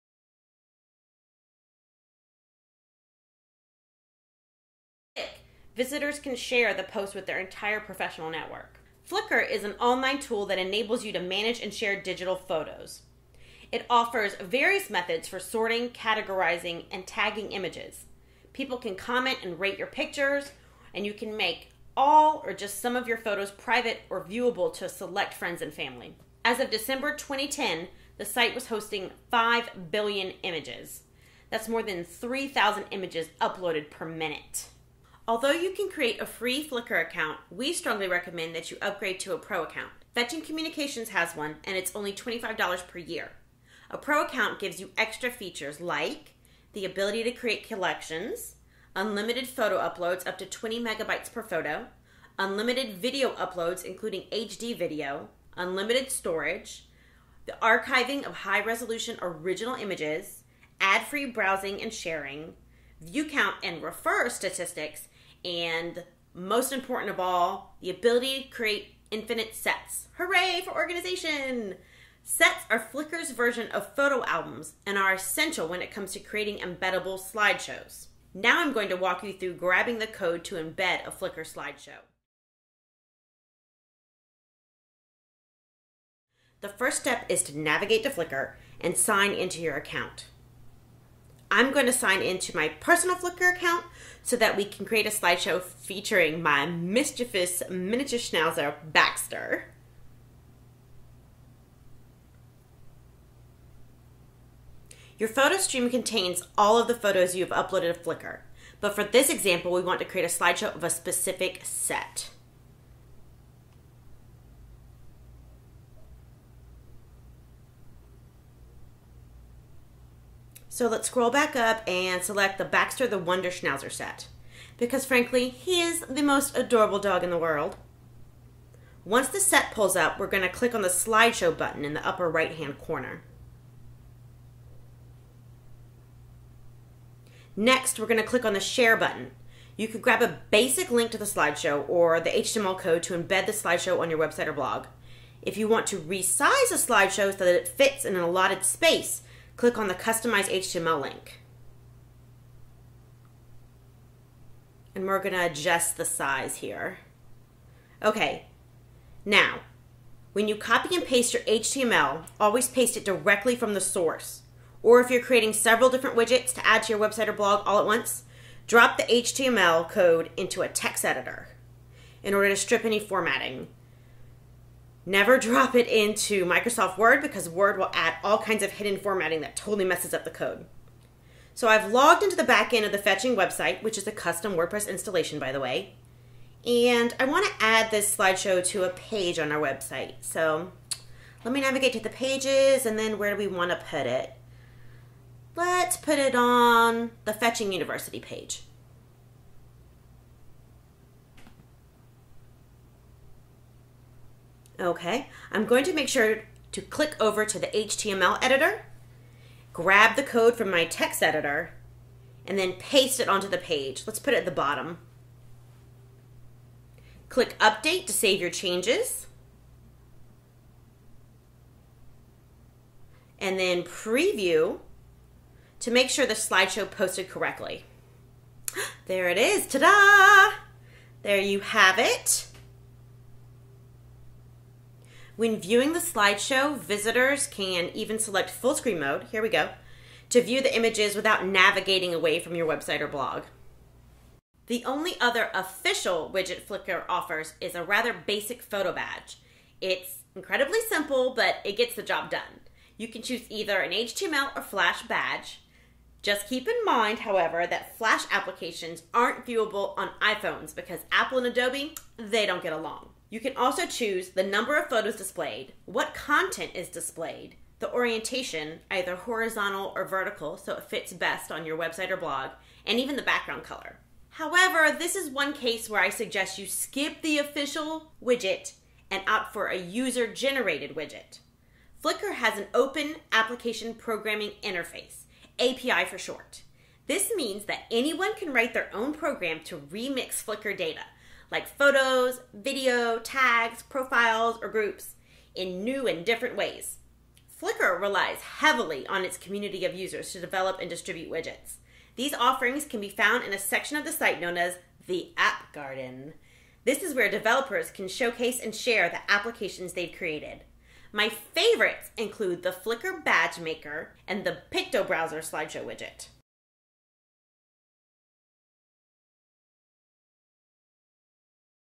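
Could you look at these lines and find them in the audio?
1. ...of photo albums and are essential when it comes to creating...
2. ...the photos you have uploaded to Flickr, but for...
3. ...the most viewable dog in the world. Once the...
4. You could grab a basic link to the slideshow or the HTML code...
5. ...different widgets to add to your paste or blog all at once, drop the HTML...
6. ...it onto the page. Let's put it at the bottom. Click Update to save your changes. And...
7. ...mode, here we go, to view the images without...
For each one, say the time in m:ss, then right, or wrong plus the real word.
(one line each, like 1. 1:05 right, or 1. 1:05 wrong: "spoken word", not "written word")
1. 1:13 right
2. 1:46 right
3. 2:06 wrong: "adorable", not "viewable"
4. 2:19 right
5. 2:45 wrong: "website", not "paste"
6. 3:33 right
7. 3:58 right.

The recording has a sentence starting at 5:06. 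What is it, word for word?
This is where developers can showcase and share the applications they've created.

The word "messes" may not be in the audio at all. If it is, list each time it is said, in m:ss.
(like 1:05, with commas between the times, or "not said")
2:59.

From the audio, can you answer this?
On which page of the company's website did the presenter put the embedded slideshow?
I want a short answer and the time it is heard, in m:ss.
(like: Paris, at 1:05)
Fetching University, at 3:17.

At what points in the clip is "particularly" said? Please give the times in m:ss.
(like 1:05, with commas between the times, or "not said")
not said.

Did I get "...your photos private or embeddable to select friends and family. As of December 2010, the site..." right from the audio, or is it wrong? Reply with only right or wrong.
wrong.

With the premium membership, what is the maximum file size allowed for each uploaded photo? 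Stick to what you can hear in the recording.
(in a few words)
20 megabytes.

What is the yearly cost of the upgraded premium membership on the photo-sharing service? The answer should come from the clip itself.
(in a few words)
$25.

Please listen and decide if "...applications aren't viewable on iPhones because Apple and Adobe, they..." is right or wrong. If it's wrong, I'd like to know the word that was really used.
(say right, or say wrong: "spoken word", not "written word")
right.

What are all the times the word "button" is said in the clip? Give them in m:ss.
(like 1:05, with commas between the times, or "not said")
2:11, 2:18.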